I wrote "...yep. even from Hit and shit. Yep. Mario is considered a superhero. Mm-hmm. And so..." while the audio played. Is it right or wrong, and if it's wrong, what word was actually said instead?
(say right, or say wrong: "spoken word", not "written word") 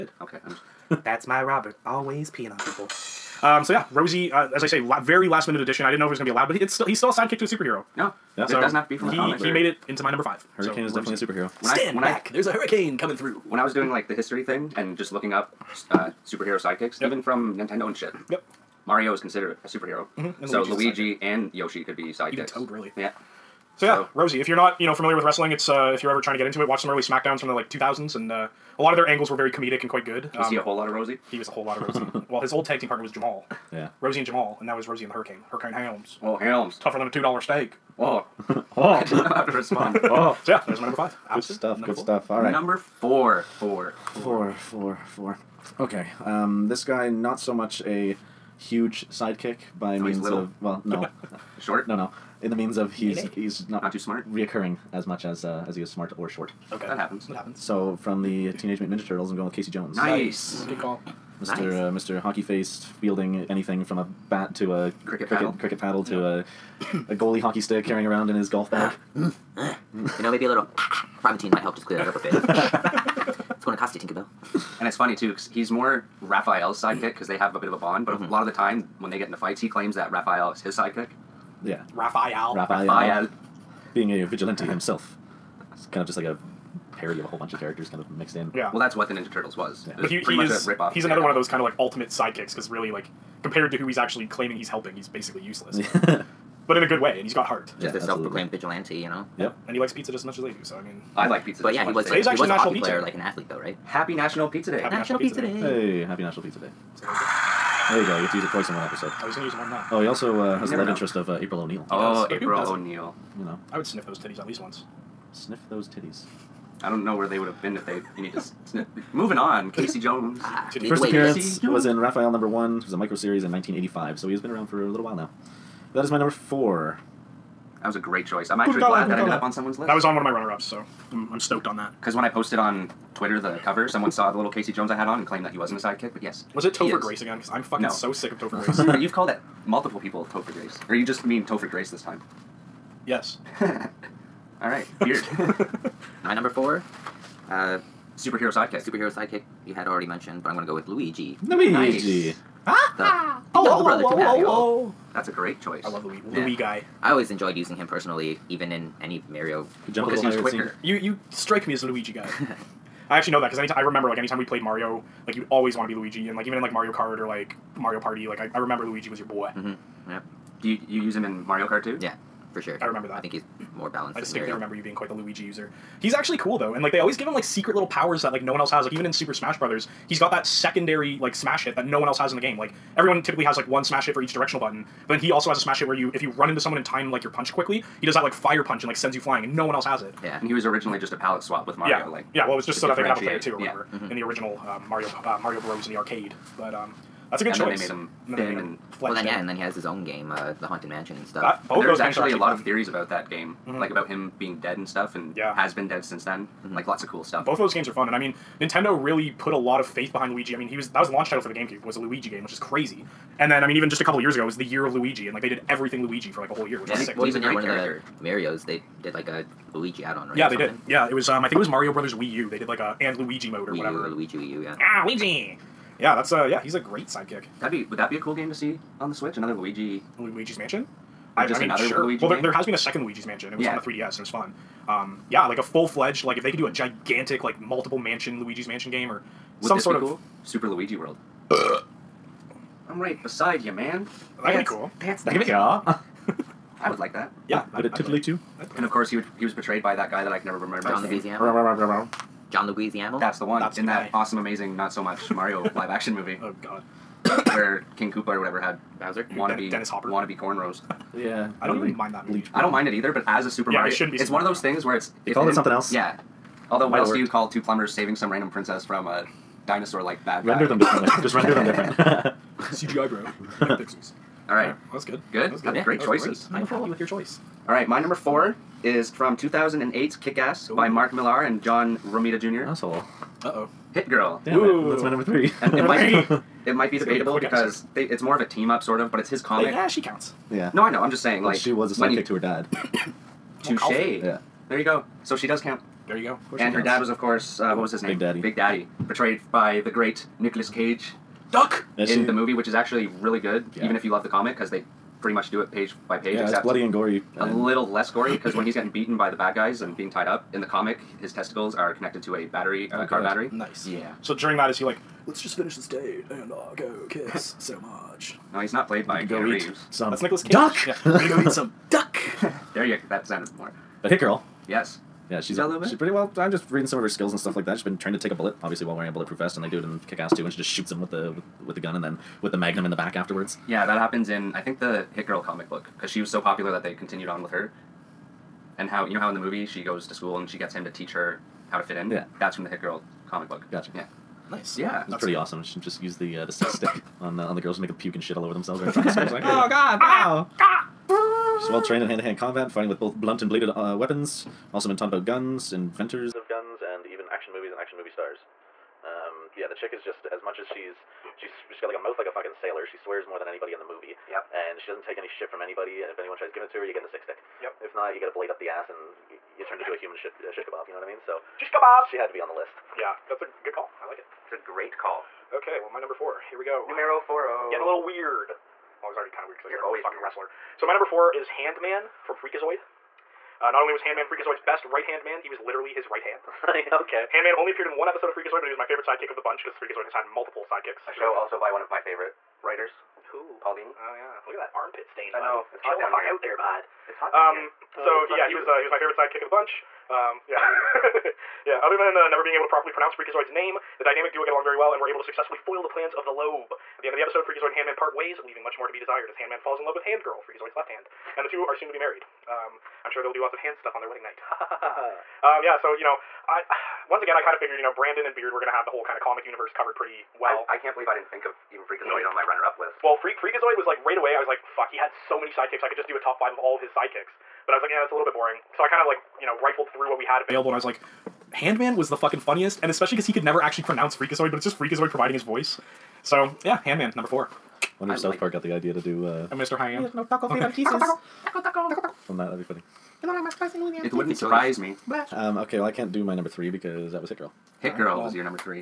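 wrong: "Nintendo", not "Hit".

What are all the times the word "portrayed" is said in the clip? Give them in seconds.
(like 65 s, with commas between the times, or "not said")
249 s, 299 s.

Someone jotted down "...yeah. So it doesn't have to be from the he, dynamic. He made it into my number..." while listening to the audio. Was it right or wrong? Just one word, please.
wrong.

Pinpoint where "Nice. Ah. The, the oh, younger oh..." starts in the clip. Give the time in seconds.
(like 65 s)
152 s.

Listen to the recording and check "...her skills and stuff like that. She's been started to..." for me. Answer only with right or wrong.
wrong.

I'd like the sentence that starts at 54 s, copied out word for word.
reoccurring as much as uh, as he is smart or short.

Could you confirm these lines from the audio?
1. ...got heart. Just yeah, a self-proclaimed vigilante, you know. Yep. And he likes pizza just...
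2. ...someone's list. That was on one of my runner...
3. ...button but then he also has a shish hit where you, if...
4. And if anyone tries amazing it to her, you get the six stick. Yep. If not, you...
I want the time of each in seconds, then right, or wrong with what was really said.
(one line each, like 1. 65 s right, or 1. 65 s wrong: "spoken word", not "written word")
1. 97 s right
2. 129 s right
3. 184 s wrong: "smash", not "shish"
4. 366 s wrong: "giving", not "amazing".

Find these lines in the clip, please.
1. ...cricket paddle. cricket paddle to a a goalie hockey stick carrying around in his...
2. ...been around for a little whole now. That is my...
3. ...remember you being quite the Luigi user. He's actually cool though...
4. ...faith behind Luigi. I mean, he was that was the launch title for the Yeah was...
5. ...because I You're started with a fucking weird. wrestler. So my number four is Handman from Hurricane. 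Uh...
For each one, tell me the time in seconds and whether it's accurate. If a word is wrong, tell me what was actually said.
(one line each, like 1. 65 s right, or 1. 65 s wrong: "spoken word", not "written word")
1. 65 s right
2. 124 s wrong: "while", not "whole"
3. 174 s right
4. 209 s wrong: "GameCube", not "Yeah"
5. 379 s wrong: "Freakazoid", not "Hurricane".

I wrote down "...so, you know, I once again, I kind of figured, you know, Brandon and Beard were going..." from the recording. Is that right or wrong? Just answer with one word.
right.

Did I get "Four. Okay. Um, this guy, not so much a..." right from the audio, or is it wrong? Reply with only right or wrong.
right.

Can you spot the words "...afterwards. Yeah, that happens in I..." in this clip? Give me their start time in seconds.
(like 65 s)
333 s.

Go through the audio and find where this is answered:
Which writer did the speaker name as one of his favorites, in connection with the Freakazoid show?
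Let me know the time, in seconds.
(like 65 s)
393 s.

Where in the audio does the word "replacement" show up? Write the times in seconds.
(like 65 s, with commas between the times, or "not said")
not said.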